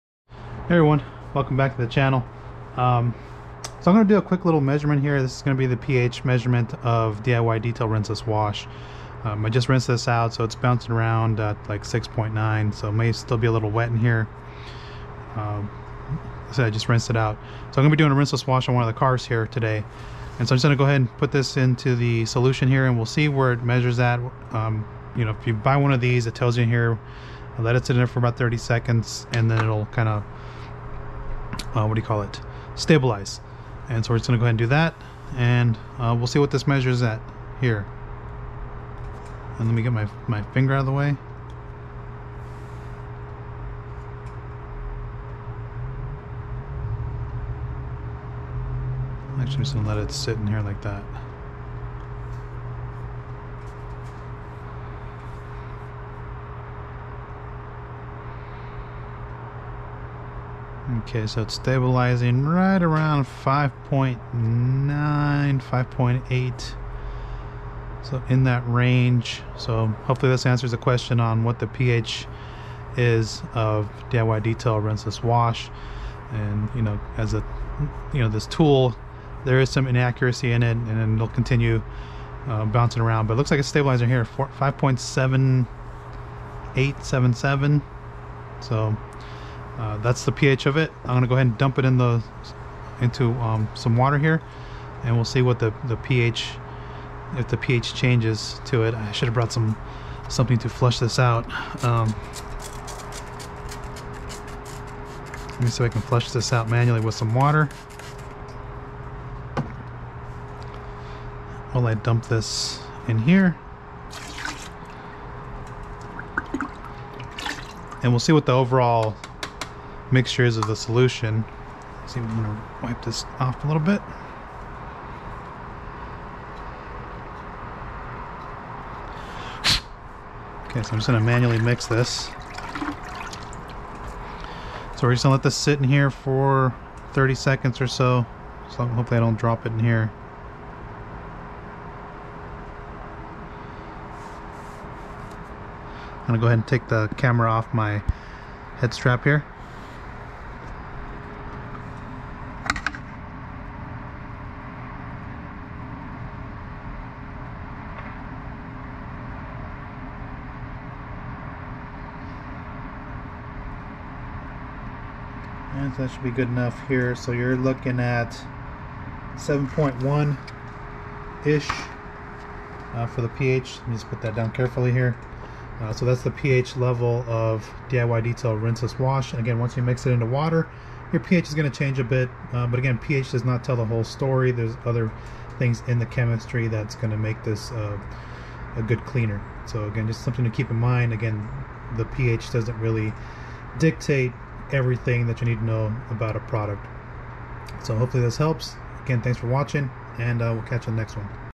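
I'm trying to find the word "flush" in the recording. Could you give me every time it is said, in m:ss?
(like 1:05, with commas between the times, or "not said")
1:40, 1:46.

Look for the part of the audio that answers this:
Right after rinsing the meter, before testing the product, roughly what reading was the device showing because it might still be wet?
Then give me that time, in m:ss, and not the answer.
0:11.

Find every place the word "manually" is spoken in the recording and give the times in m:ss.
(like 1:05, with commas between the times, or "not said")
1:46, 2:11.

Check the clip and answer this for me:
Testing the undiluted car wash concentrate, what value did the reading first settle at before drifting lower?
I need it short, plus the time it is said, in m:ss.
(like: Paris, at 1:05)
5.9, at 1:03.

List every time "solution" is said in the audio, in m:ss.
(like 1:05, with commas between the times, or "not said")
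0:22, 2:00.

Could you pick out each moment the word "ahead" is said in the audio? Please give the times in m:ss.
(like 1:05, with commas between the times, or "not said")
0:20, 0:34, 1:31, 2:26.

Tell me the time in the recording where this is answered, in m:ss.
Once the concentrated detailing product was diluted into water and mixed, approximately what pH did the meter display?
2:49.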